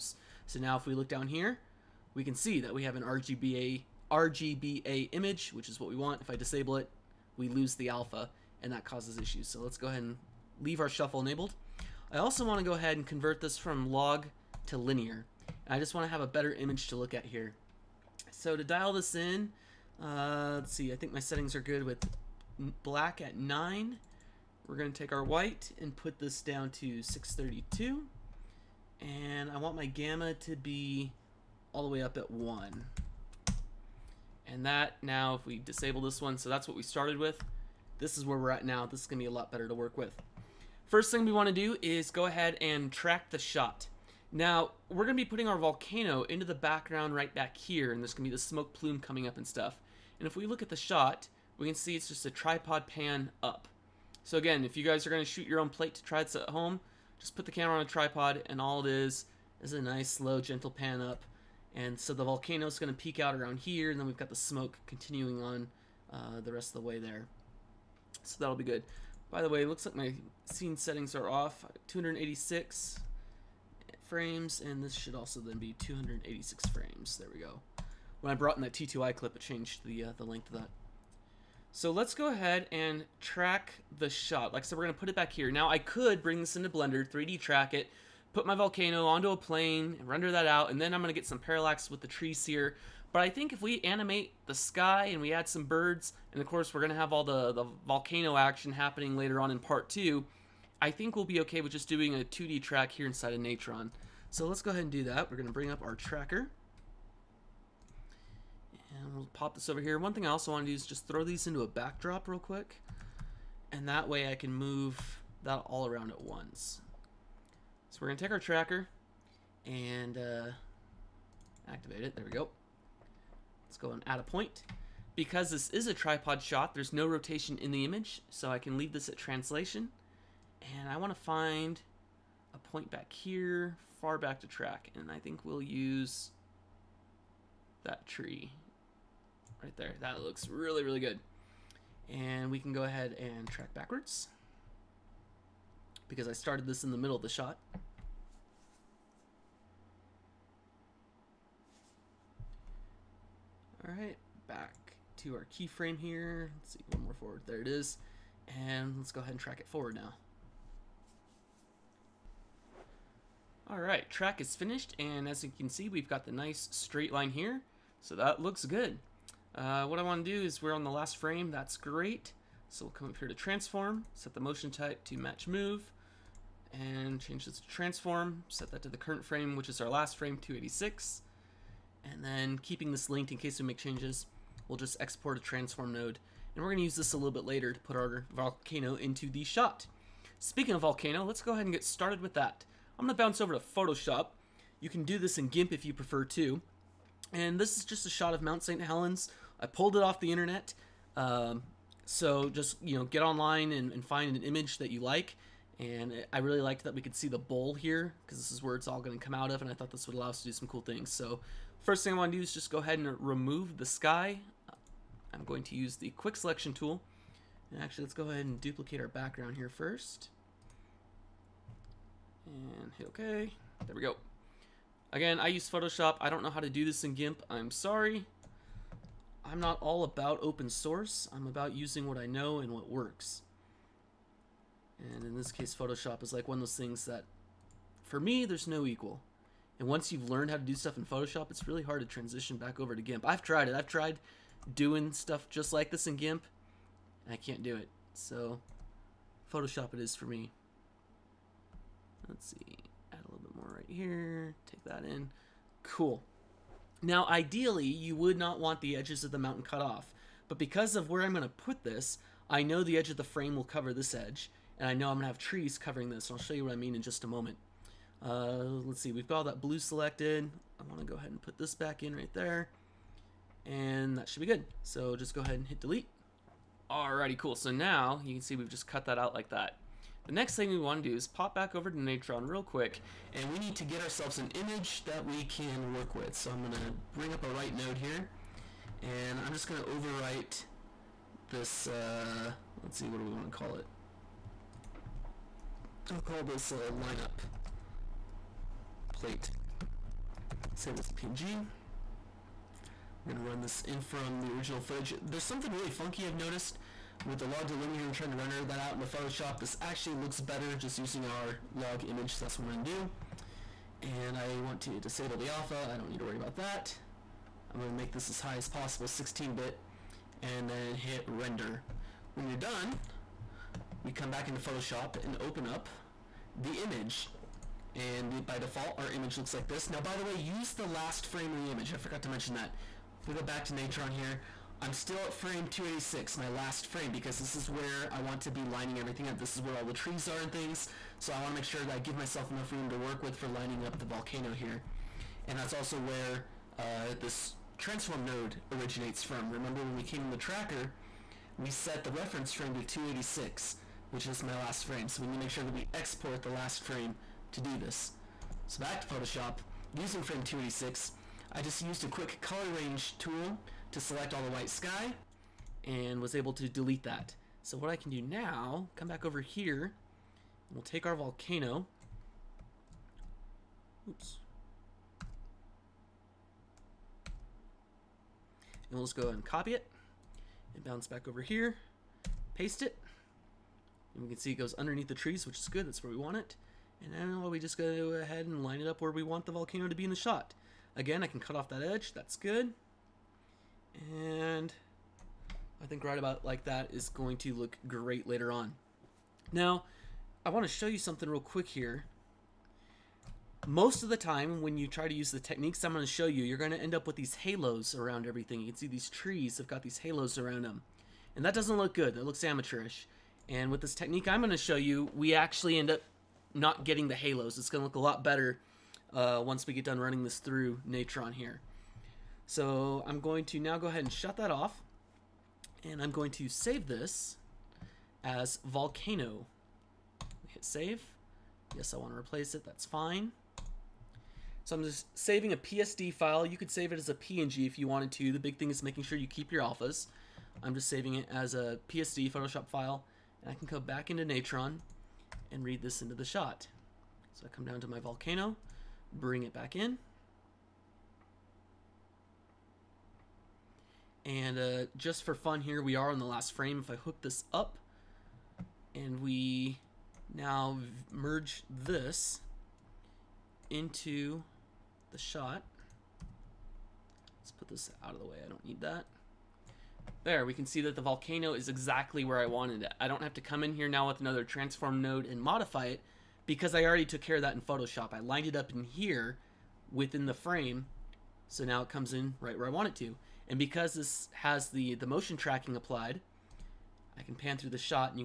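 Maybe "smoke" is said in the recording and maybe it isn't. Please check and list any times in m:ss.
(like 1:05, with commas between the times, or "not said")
0:48, 1:04.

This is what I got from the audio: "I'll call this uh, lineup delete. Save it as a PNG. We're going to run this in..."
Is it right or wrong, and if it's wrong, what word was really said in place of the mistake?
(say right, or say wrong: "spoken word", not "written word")
wrong: "plate", not "delete".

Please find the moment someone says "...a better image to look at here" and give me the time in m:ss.
0:16.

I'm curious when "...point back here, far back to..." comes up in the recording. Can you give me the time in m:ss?
2:12.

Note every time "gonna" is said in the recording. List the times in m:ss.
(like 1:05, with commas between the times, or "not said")
3:06, 3:13.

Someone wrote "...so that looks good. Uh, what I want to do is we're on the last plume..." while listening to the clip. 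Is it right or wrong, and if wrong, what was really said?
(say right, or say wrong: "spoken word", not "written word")
wrong: "frame", not "plume".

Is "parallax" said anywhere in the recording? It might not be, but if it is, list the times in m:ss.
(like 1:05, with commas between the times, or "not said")
1:31.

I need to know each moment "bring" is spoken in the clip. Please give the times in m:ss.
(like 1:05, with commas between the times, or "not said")
1:26, 1:45, 4:47, 7:29.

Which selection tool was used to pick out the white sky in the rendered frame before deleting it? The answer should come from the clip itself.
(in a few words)
color range tool.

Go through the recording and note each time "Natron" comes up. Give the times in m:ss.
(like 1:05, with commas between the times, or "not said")
1:43, 4:42, 5:33, 7:00, 7:24.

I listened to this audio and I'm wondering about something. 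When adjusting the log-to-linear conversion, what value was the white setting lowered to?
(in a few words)
632.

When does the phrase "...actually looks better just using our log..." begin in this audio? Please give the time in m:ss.
5:09.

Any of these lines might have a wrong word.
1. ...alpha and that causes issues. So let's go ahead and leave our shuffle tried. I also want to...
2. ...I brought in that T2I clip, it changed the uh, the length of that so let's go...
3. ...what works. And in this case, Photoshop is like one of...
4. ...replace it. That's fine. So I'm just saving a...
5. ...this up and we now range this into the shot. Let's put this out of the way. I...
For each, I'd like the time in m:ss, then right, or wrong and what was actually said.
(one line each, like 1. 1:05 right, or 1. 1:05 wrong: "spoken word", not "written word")
1. 0:07 wrong: "enabled", not "tried"
2. 1:18 right
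3. 3:52 right
4. 7:12 right
5. 7:37 wrong: "merge", not "range".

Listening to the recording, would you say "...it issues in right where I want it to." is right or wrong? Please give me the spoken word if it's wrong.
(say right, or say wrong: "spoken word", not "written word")
wrong: "comes", not "issues".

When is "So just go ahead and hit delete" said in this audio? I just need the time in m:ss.
4:34.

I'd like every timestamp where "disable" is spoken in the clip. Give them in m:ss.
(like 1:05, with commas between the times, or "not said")
0:06, 0:35, 5:14.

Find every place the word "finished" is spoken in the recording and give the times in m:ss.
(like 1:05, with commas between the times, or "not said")
2:44.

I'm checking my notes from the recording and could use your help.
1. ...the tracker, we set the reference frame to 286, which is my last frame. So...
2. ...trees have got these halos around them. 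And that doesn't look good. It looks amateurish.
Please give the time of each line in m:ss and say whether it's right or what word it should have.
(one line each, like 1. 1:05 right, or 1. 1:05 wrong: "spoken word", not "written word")
1. 5:50 right
2. 6:49 right.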